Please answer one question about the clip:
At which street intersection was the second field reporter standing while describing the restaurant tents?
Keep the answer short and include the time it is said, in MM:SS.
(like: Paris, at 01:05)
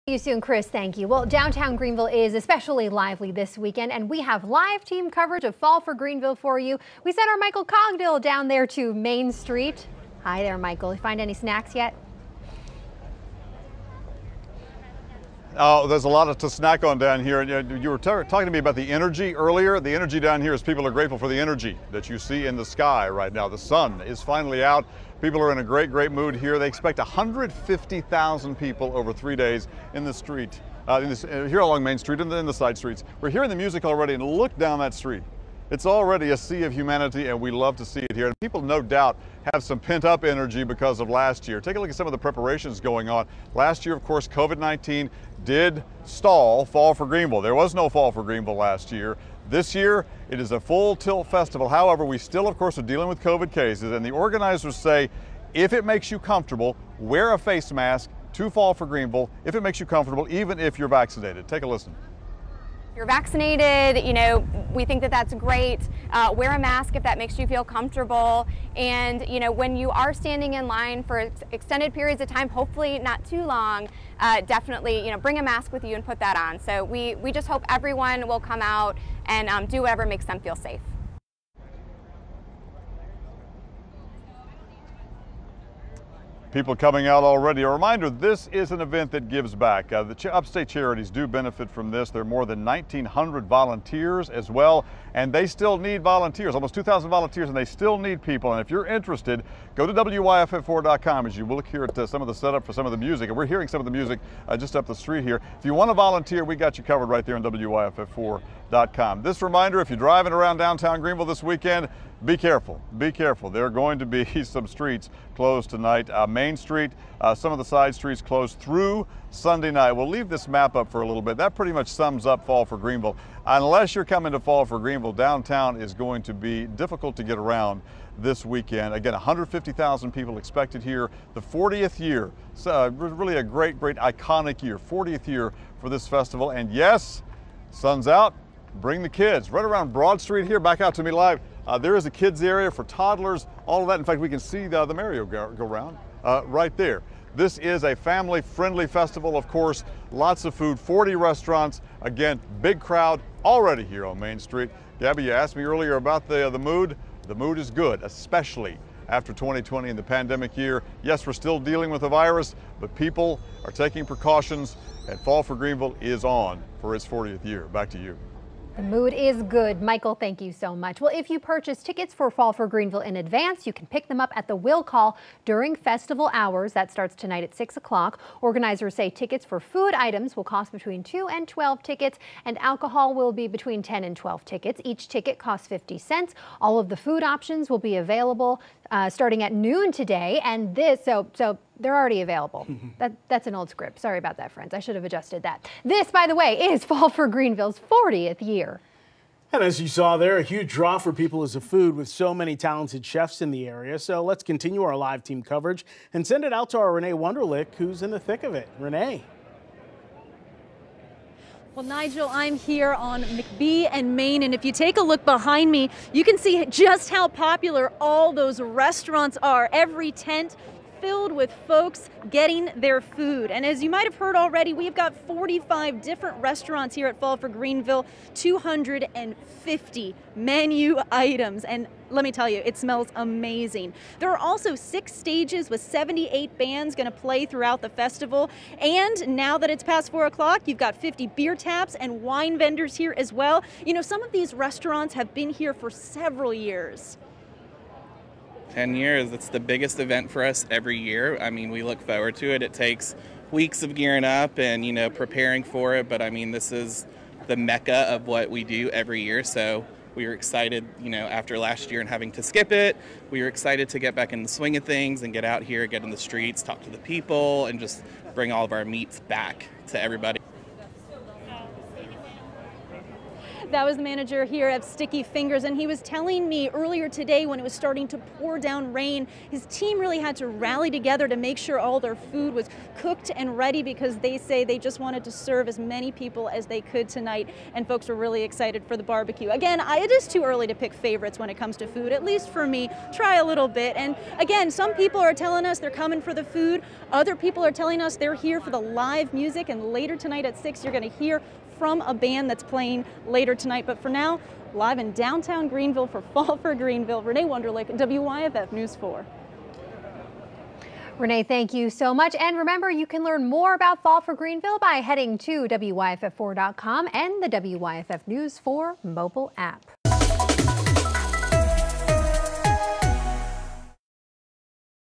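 McBee and Main, at 03:33.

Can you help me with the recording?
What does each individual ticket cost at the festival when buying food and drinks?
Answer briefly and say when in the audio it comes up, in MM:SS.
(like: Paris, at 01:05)
50 cents, at 03:05.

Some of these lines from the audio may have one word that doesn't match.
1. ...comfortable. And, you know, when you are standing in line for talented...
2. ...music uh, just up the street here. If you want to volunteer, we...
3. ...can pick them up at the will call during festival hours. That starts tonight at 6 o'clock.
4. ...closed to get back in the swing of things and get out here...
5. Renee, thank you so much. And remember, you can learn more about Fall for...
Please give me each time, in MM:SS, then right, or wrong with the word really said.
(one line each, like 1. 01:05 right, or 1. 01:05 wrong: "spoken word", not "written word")
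1. 01:07 wrong: "extended", not "talented"
2. 01:43 right
3. 02:53 right
4. 04:23 wrong: "excited", not "closed"
5. 05:11 right.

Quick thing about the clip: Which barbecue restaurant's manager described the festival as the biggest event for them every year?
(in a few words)
Sticky Fingers.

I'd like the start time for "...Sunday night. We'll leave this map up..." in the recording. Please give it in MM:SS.
01:59.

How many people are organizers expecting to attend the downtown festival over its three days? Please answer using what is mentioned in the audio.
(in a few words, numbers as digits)
150,000.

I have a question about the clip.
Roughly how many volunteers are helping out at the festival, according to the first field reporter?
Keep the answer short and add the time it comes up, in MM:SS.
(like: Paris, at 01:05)
1,900, at 01:32.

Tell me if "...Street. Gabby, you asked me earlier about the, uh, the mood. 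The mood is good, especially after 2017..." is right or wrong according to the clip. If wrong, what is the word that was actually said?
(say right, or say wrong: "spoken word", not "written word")
wrong: "2020", not "2017".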